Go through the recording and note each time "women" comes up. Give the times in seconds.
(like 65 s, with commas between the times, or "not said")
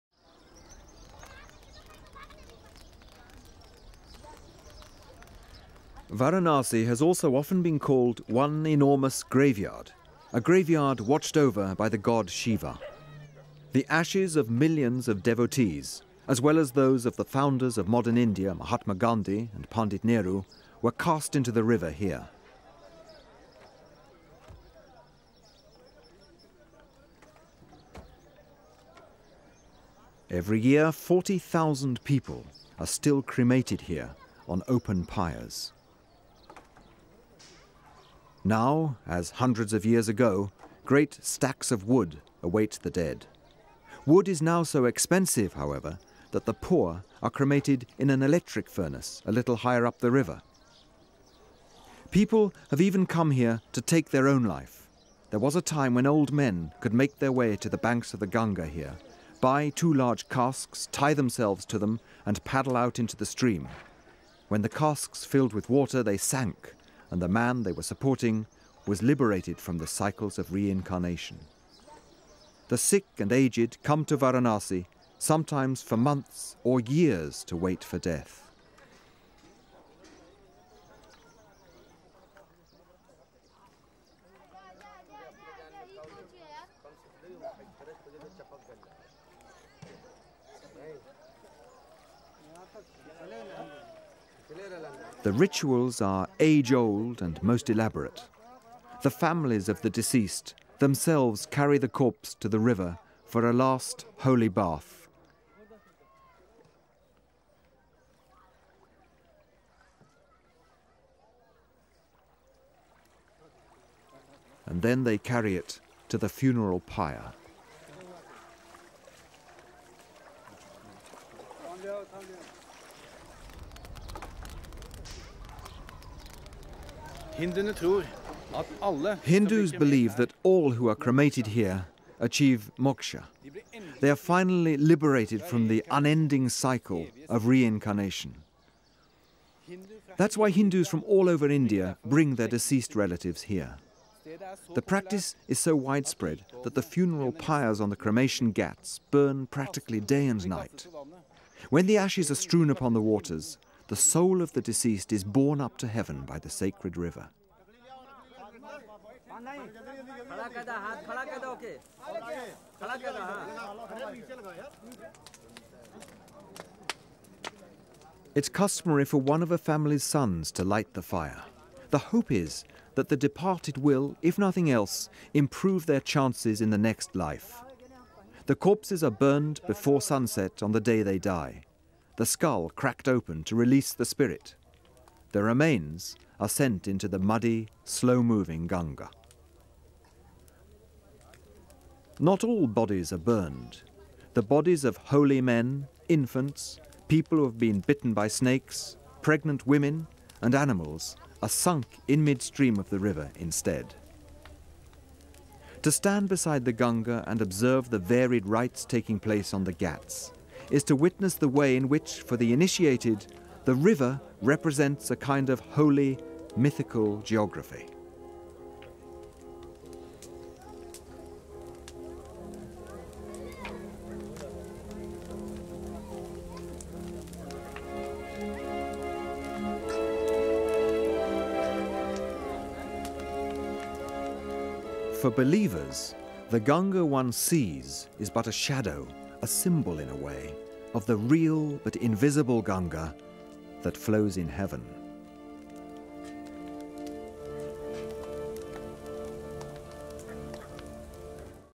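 199 s.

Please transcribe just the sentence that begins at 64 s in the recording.
When the casks filled with water, they sank, and the man they were supporting was liberated from the cycles of reincarnation.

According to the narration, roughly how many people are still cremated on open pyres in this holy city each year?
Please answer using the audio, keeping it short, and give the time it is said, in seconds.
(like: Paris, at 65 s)
40,000, at 30 s.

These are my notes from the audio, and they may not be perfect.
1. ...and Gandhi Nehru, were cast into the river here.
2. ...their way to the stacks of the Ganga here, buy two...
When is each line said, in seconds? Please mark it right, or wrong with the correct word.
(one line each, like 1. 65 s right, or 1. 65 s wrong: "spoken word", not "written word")
1. 19 s wrong: "Pandit", not "Gandhi"
2. 57 s wrong: "banks", not "stacks".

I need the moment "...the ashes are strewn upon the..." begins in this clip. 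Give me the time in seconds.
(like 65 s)
151 s.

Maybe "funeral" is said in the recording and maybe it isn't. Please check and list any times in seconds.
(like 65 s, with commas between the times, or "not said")
116 s, 146 s.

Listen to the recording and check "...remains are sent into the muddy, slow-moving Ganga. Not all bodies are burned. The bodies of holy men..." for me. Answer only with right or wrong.
right.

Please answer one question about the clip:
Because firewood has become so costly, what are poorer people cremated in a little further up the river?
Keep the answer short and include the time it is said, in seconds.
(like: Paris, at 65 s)
An electric furnace, at 48 s.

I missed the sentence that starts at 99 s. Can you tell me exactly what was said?
The families of the deceased themselves carry the corpse to the river for a last holy bath.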